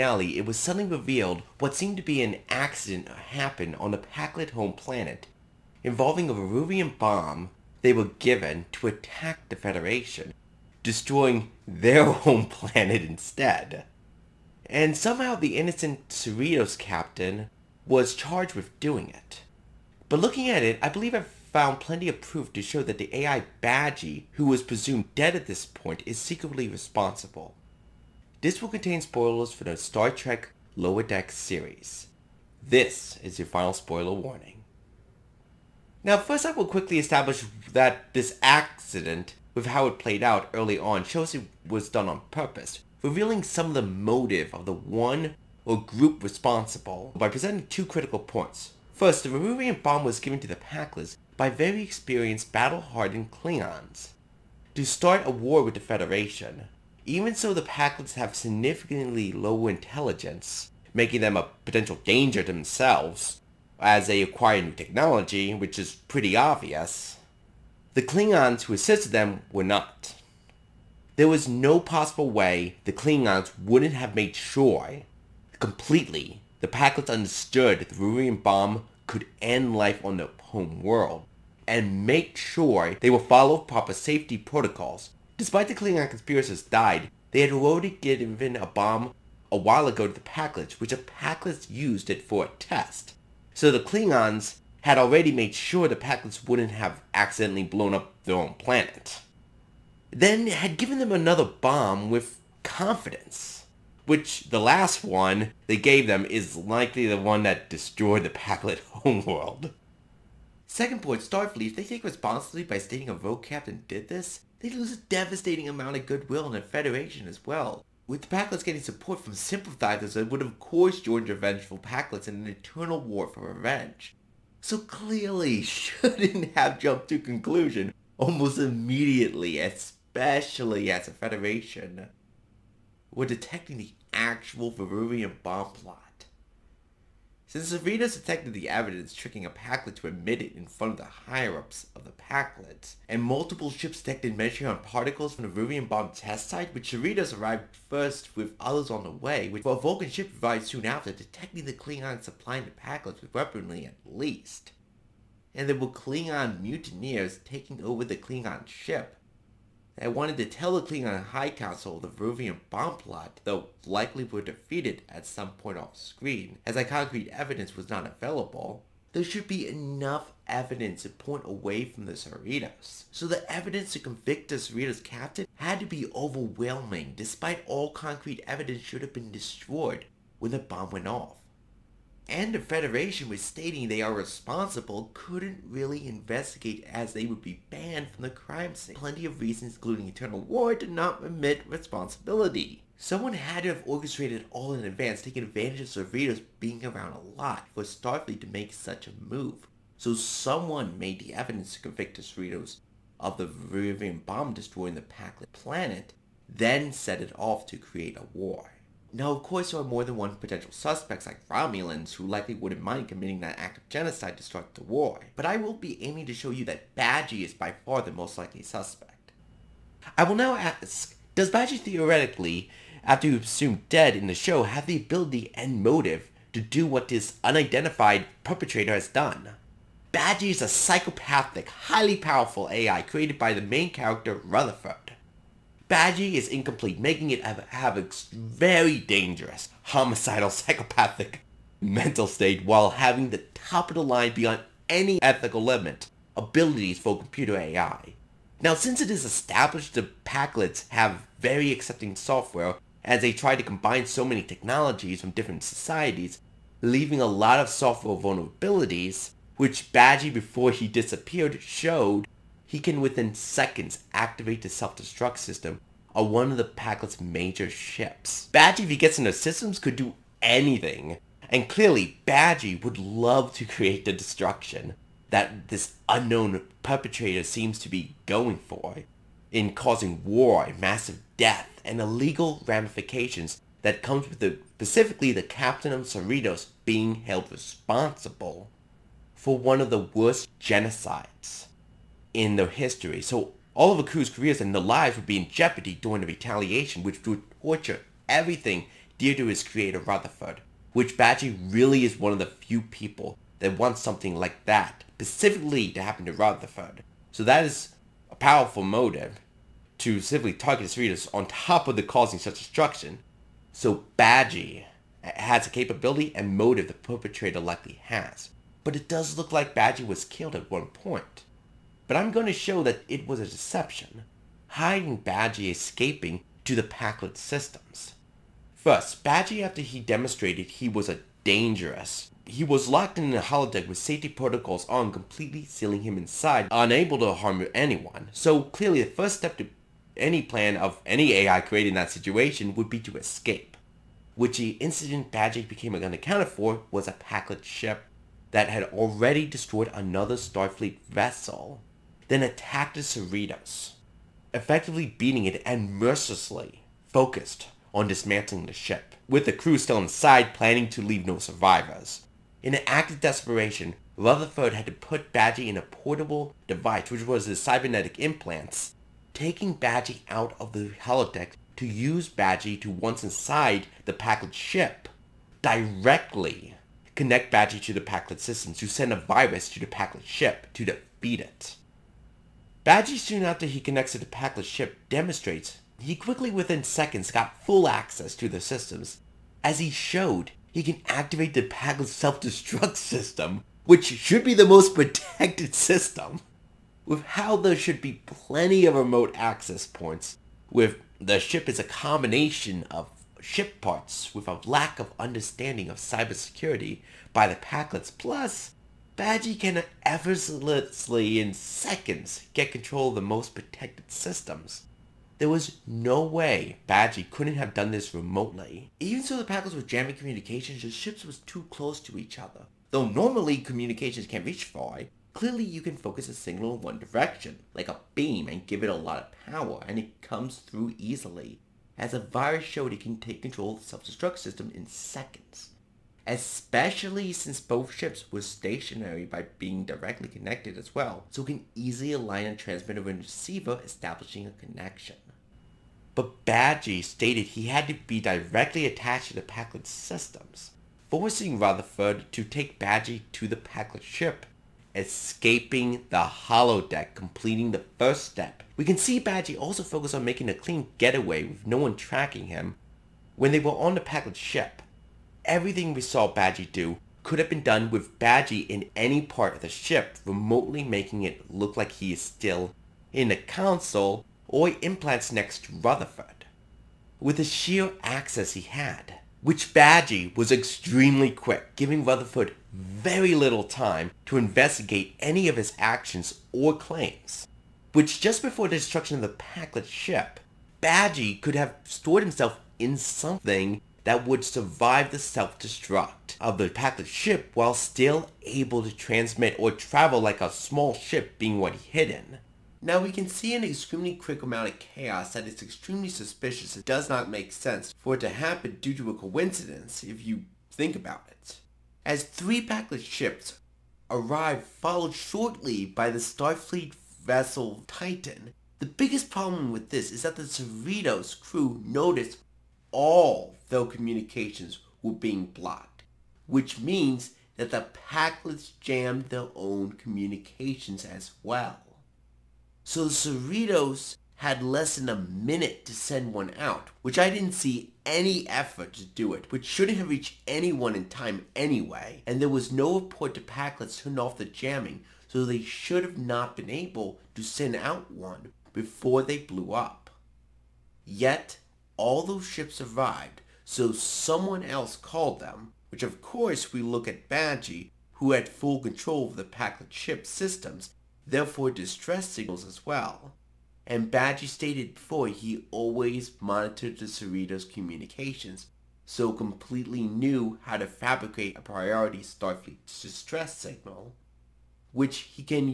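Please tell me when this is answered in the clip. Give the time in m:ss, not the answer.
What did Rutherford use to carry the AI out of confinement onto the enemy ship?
6:07.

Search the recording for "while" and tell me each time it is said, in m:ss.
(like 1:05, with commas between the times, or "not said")
1:29, 4:02, 8:17.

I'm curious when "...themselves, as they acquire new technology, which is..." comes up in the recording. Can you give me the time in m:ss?
1:02.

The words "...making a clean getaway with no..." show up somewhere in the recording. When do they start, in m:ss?
7:40.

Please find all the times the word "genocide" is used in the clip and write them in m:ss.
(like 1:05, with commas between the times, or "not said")
3:33, 4:50.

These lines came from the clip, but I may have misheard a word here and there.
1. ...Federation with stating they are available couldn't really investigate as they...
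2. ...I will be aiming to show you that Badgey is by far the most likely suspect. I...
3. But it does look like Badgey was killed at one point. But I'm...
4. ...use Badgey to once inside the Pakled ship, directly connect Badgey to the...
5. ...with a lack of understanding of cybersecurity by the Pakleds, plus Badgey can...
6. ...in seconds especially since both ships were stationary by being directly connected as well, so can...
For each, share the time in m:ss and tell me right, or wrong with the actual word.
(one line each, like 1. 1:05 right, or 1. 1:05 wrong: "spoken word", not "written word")
1. 3:02 wrong: "responsible", not "available"
2. 3:35 right
3. 5:18 right
4. 6:11 right
5. 6:44 right
6. 7:14 right.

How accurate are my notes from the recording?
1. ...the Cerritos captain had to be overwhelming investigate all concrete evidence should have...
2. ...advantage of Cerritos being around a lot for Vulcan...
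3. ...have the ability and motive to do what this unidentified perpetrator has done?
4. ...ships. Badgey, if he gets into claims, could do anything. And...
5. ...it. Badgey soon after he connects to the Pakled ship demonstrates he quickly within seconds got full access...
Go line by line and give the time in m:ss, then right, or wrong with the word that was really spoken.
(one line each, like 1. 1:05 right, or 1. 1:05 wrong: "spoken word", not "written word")
1. 2:54 wrong: "despite", not "investigate"
2. 3:15 wrong: "Starfleet", not "Vulcan"
3. 3:44 right
4. 4:27 wrong: "systems", not "claims"
5. 6:21 right.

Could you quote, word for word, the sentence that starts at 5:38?
So clearly the first step to any plan of any AI created in that situation would be to escape.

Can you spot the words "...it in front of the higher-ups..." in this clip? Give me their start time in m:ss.
2:20.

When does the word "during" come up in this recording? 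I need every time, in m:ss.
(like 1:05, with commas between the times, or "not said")
4:55.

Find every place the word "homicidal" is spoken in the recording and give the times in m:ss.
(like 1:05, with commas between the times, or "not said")
3:59.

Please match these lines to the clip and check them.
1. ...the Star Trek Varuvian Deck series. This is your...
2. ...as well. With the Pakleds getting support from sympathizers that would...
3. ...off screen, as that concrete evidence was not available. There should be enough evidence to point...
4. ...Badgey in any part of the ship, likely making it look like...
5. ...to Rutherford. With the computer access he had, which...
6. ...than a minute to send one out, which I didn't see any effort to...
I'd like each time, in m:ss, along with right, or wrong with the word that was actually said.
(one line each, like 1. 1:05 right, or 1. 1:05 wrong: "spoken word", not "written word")
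1. 0:29 wrong: "Lower", not "Varuvian"
2. 1:57 right
3. 2:45 right
4. 7:48 wrong: "remotely", not "likely"
5. 7:55 wrong: "sheer", not "computer"
6. 8:54 right.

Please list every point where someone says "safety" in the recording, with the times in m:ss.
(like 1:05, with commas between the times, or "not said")
1:23, 5:33.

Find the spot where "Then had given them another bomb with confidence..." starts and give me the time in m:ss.
1:40.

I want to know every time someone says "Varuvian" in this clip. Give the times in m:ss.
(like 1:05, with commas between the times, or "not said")
0:06, 0:49, 1:17, 2:14, 2:25, 2:42, 3:23.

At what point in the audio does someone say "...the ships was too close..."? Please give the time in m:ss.
7:00.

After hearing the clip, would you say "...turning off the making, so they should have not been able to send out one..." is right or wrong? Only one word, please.
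wrong.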